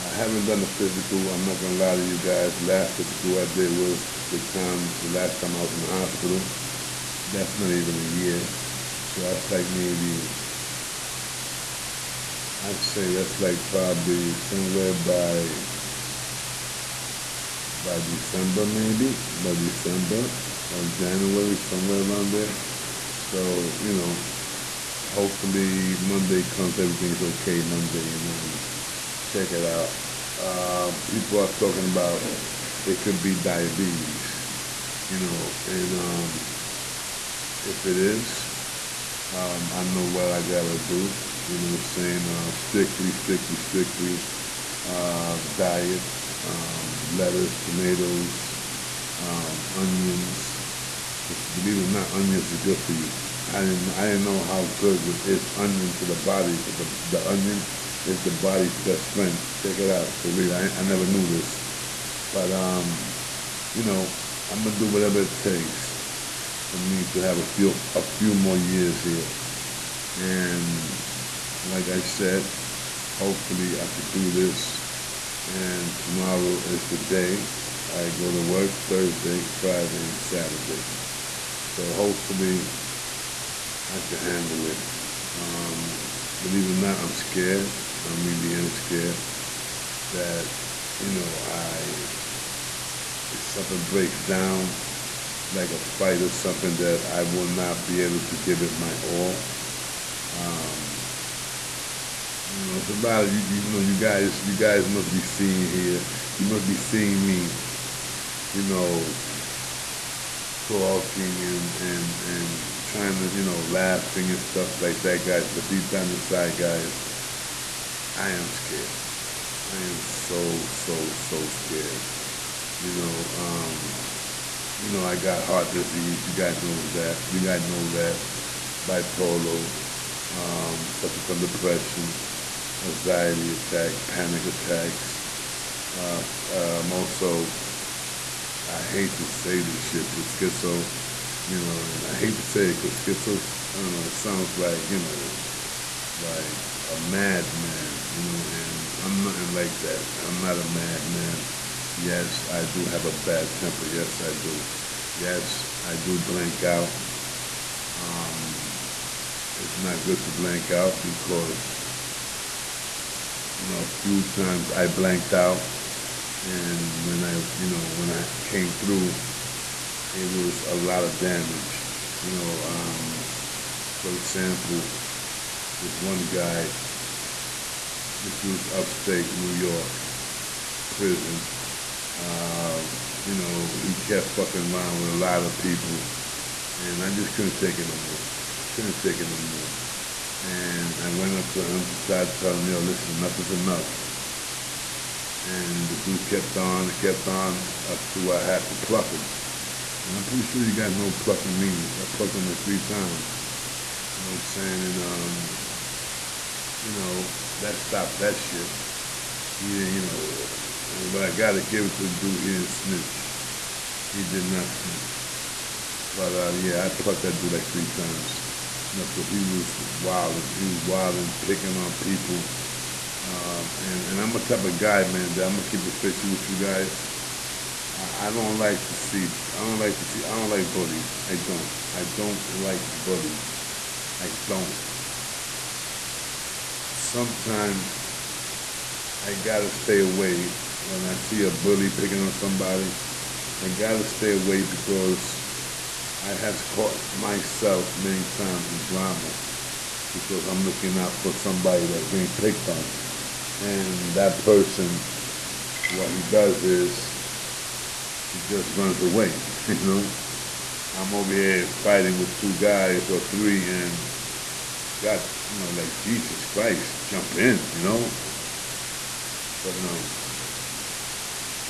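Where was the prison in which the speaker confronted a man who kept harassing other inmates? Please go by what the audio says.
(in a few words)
Upstate New York.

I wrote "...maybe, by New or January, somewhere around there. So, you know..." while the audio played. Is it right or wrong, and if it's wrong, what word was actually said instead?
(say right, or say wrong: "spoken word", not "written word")
wrong: "December", not "New".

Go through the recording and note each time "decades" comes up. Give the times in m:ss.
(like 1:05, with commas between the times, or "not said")
not said.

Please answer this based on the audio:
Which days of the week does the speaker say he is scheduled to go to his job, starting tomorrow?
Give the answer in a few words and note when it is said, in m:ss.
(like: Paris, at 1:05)
Thursday, Friday, and Saturday, at 1:18.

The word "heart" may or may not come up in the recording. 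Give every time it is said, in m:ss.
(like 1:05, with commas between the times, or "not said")
2:05.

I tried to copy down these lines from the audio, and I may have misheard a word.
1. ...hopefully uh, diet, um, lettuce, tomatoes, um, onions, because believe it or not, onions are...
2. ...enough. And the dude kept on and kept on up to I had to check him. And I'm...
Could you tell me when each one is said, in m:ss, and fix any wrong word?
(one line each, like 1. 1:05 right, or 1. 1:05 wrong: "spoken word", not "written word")
1. 0:43 wrong: "strictly", not "hopefully"
2. 3:13 wrong: "pluck", not "check".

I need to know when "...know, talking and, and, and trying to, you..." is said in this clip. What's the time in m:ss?
1:48.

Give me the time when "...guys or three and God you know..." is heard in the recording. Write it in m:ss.
4:22.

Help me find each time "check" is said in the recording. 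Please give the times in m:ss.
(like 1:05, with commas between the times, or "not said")
0:29, 0:59.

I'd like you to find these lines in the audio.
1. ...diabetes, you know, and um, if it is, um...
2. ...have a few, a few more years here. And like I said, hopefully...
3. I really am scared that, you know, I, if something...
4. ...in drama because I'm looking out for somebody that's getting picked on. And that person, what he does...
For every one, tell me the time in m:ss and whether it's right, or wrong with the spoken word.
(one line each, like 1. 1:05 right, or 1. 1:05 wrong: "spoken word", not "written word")
1. 0:33 right
2. 1:07 right
3. 1:28 right
4. 4:08 right.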